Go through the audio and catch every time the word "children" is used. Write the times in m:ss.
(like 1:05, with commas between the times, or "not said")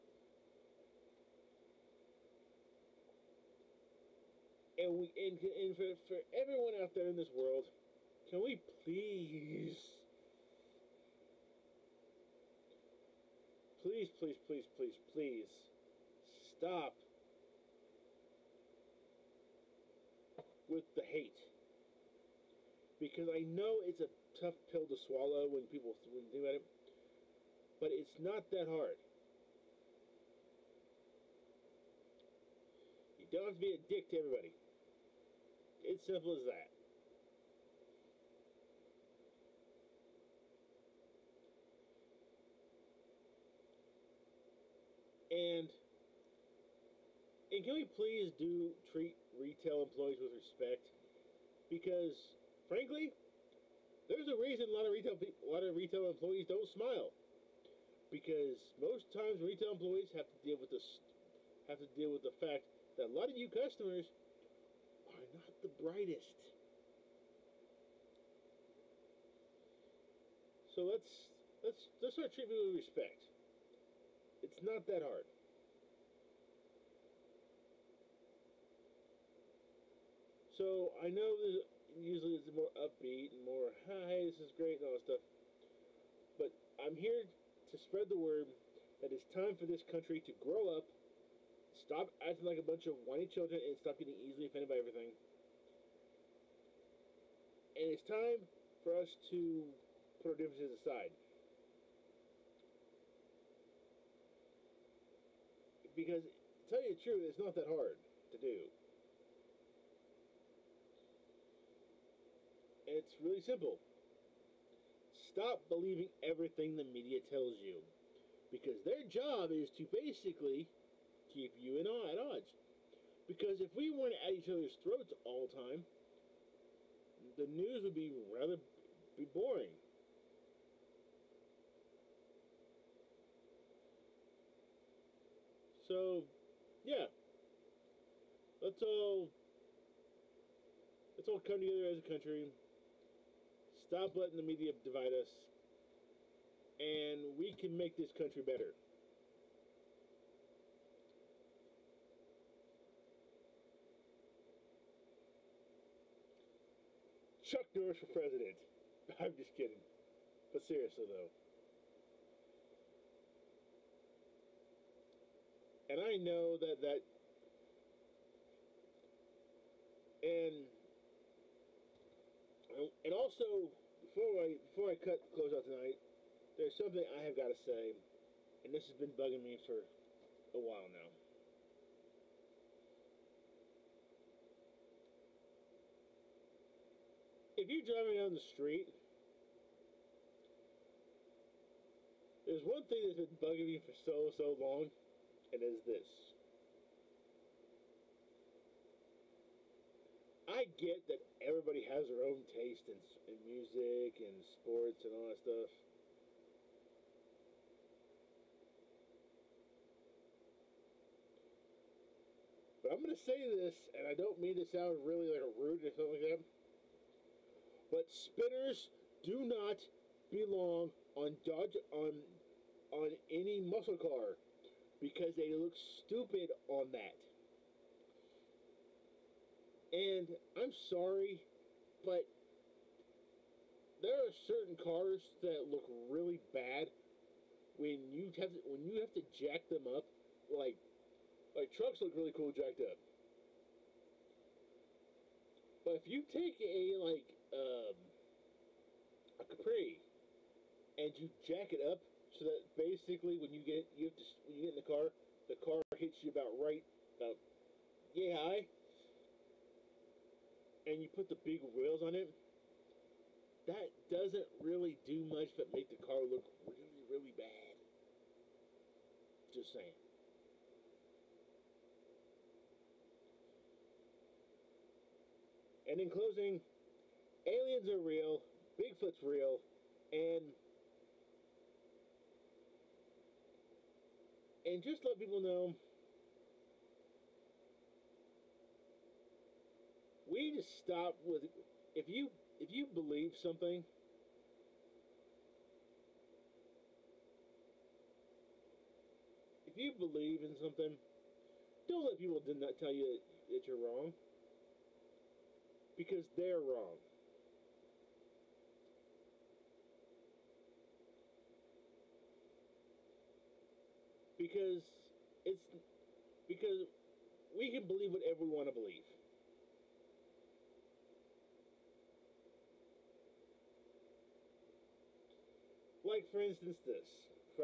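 1:33.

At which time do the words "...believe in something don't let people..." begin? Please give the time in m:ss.
4:59.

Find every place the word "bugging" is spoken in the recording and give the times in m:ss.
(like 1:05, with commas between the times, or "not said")
2:59, 3:13.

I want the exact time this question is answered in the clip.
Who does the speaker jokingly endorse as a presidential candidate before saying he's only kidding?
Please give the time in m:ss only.
2:37.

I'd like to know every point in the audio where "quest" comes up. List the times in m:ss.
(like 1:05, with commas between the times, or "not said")
not said.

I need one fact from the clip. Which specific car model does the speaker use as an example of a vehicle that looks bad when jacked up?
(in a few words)
Capri.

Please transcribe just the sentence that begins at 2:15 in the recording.
So, yeah, let's all let's all come together as a country Stop letting the media divide us.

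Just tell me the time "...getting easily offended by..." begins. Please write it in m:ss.
1:33.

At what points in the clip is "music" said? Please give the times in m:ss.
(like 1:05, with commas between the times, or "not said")
3:23.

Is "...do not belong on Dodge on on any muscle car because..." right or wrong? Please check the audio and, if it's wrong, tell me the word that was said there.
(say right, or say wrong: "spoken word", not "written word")
right.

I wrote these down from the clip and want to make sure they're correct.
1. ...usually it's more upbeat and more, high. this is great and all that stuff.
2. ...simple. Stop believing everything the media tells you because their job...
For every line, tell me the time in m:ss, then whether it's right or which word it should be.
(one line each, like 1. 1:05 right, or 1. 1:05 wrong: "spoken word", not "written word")
1. 1:21 right
2. 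1:53 right.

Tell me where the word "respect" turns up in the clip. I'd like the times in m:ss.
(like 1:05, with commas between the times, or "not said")
0:50, 1:12.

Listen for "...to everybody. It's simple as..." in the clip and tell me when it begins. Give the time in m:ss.
0:34.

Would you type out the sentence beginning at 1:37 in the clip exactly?
And it's time for us to put our differences aside.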